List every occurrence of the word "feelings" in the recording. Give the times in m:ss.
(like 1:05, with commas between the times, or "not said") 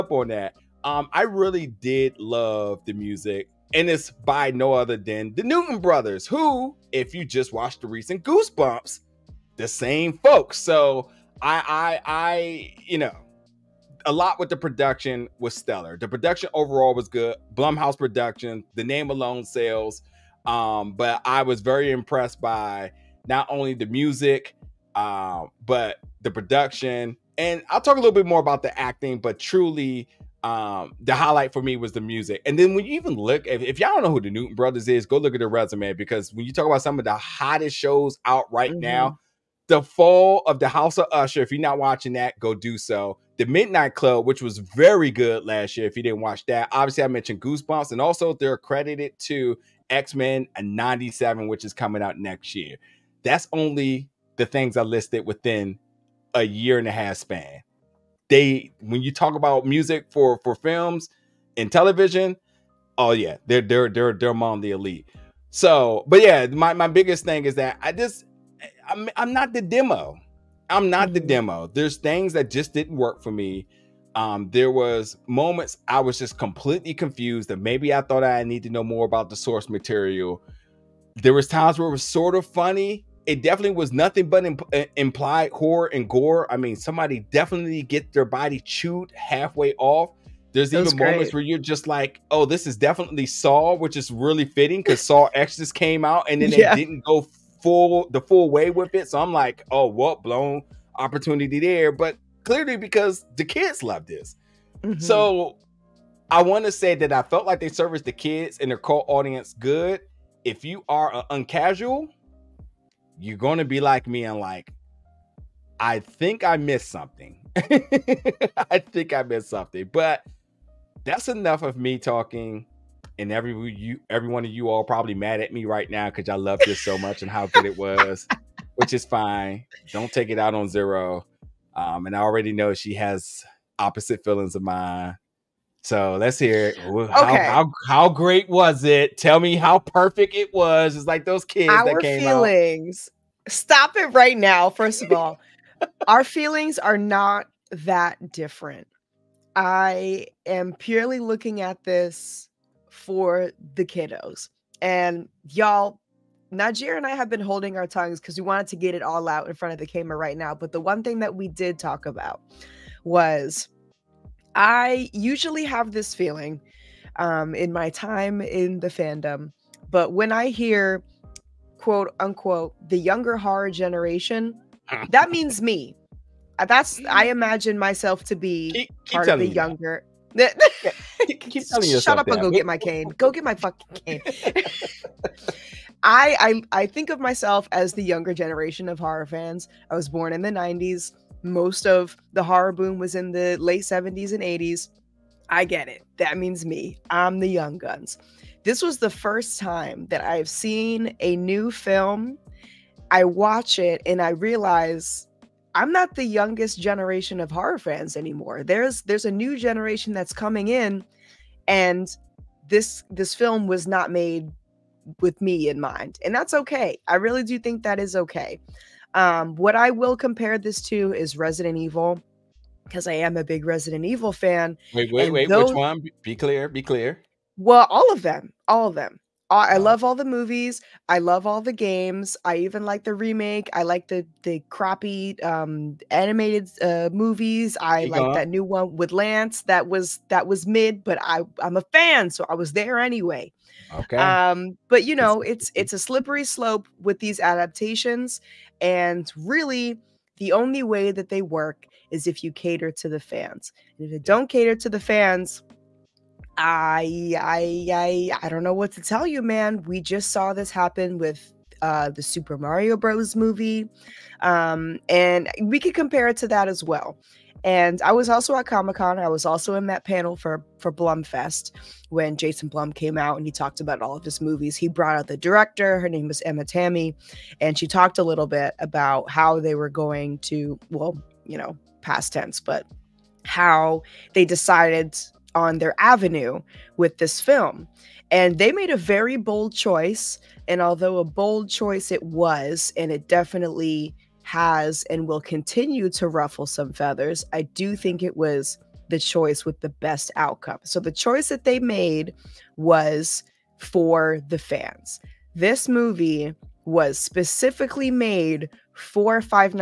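2:14, 2:22, 2:26, 2:46.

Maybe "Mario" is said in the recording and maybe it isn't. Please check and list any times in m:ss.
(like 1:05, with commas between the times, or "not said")
4:22.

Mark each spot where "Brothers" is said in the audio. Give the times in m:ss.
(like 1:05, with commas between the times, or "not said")
0:05, 0:34.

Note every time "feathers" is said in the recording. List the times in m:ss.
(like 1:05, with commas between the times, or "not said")
4:56.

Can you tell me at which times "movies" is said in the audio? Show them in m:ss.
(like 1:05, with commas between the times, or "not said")
3:50, 3:57, 4:23, 4:34, 5:05.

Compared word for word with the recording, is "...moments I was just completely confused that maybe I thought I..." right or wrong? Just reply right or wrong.
right.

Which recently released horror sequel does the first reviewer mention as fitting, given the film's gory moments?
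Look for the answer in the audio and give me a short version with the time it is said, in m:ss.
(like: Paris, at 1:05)
Saw X, at 1:35.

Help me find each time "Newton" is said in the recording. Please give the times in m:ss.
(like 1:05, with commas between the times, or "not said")
0:05, 0:34.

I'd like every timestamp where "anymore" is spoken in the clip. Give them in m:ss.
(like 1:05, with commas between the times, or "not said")
3:28.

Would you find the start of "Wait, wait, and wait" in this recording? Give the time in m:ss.
3:44.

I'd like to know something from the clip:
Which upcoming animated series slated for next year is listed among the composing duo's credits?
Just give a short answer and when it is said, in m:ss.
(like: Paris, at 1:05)
X Men '97, at 0:49.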